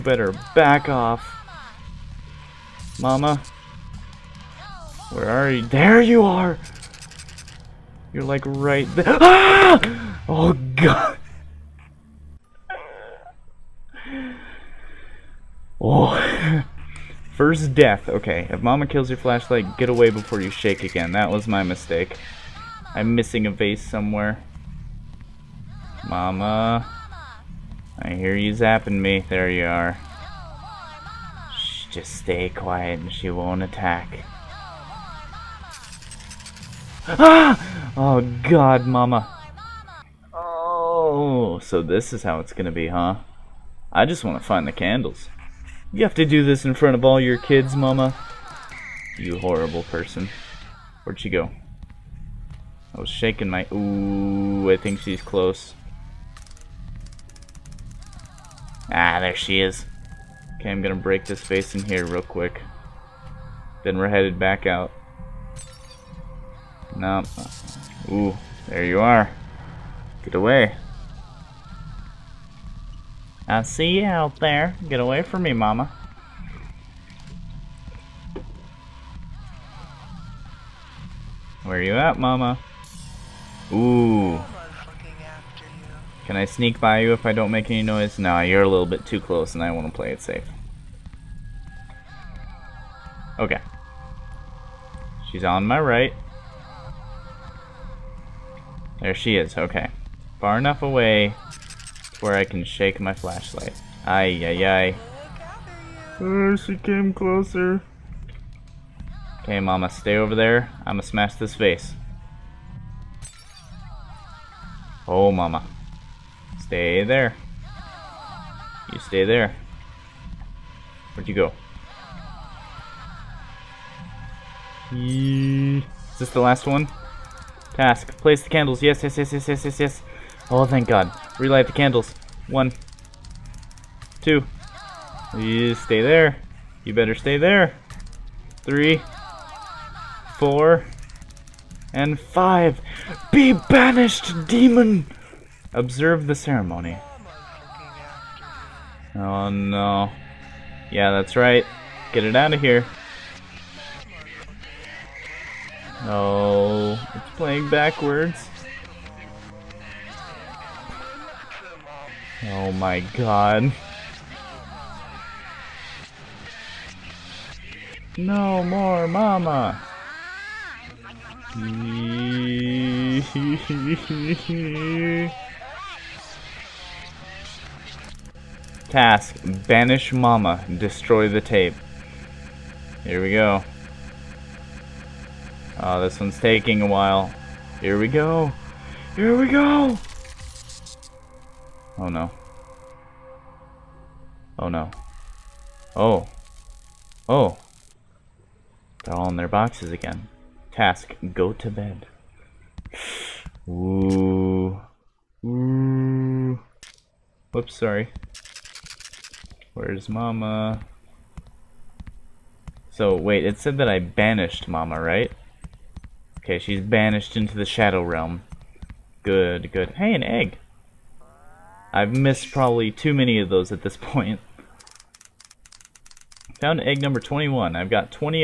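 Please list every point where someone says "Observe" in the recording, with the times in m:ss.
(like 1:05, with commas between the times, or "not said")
2:25.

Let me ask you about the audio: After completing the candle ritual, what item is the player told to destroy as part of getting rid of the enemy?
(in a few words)
The tape.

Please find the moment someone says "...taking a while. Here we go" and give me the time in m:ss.
3:06.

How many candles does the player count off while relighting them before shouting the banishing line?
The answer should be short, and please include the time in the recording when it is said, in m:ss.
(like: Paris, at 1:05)
5, at 2:22.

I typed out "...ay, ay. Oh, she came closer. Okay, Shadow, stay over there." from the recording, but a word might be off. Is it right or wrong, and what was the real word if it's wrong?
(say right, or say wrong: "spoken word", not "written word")
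wrong: "Mama", not "Shadow".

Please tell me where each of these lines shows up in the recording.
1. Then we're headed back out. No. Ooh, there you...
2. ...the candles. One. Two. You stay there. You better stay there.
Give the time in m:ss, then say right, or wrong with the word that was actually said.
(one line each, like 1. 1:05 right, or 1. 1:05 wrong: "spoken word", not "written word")
1. 1:03 right
2. 2:11 right.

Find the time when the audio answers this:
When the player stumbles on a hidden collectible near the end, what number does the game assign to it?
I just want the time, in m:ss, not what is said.
3:47.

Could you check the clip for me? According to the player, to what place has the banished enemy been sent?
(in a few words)
The Shadow Realm.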